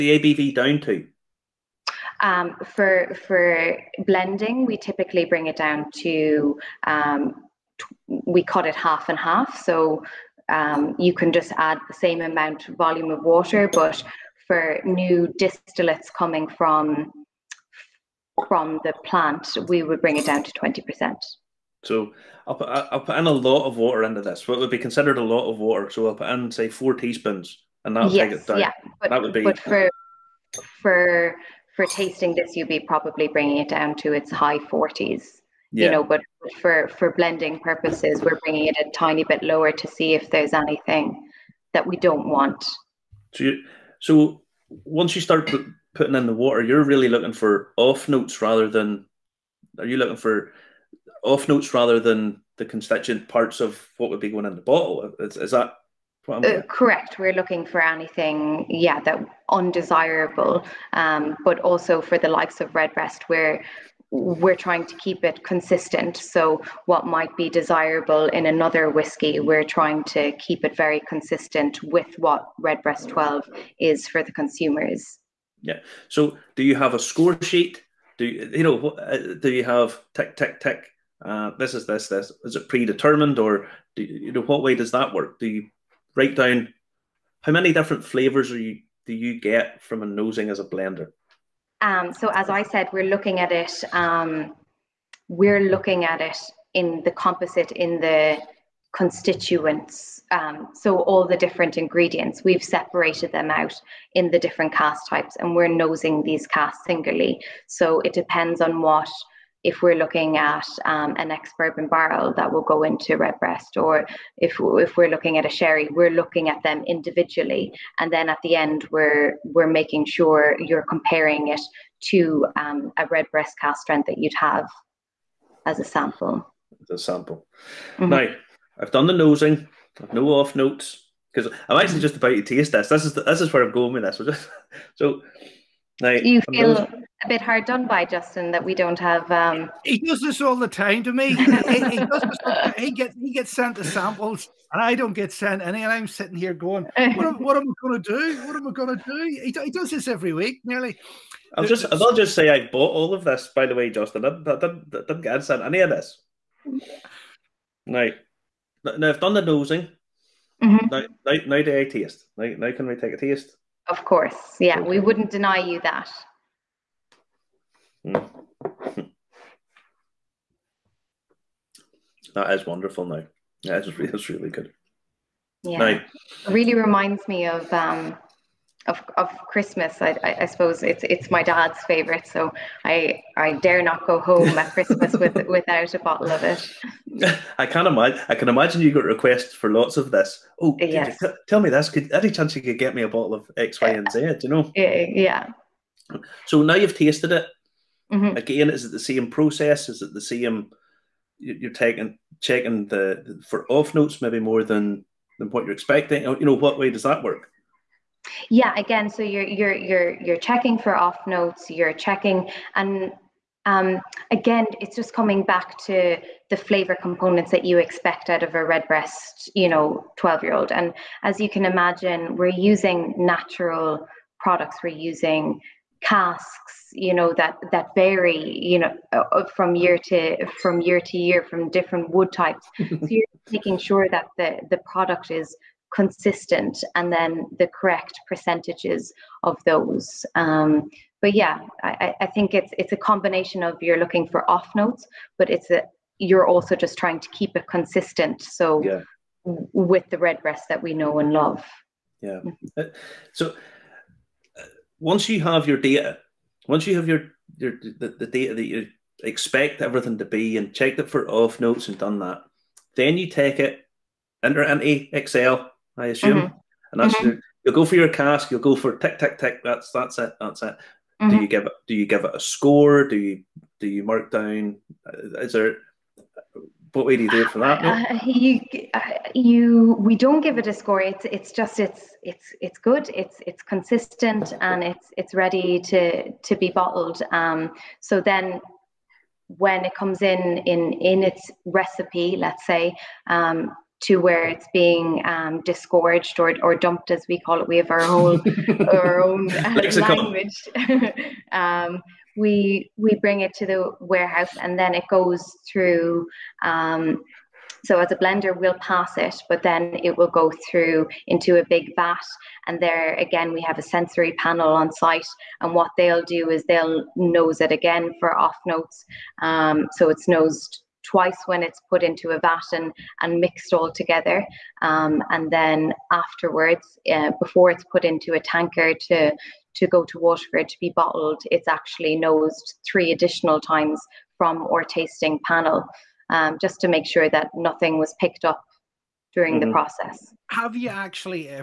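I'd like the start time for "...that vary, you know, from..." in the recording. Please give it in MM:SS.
03:47.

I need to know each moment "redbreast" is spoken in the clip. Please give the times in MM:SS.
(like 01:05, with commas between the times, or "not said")
01:02, 01:12, 01:53, 02:03, 03:38, 04:10.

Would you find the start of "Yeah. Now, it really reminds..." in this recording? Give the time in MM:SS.
02:55.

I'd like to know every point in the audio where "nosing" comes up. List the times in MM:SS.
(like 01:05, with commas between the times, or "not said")
01:30, 01:45, 02:09, 02:39.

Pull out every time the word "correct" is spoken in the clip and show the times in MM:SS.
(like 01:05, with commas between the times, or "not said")
00:56, 03:57.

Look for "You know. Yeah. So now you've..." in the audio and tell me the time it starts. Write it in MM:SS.
03:14.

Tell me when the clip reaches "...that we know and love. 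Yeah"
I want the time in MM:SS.
04:10.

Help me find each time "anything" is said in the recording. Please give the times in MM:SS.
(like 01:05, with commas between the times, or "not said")
00:40, 00:57.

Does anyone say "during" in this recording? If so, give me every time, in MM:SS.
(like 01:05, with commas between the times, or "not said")
05:39.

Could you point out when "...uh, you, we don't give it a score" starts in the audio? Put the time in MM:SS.
04:38.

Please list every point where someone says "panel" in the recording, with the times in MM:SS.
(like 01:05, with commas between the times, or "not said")
05:14, 05:35.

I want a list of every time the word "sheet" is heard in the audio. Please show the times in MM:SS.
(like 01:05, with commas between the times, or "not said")
01:17.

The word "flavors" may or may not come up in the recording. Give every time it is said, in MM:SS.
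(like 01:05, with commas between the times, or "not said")
01:28, 03:36.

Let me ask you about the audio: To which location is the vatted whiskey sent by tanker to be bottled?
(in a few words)
Waterford.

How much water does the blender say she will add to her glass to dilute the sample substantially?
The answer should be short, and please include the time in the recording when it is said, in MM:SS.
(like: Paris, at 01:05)
4 teaspoons, at 00:26.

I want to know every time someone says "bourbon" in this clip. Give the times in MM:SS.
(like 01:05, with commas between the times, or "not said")
01:51.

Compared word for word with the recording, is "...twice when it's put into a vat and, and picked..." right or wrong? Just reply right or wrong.
wrong.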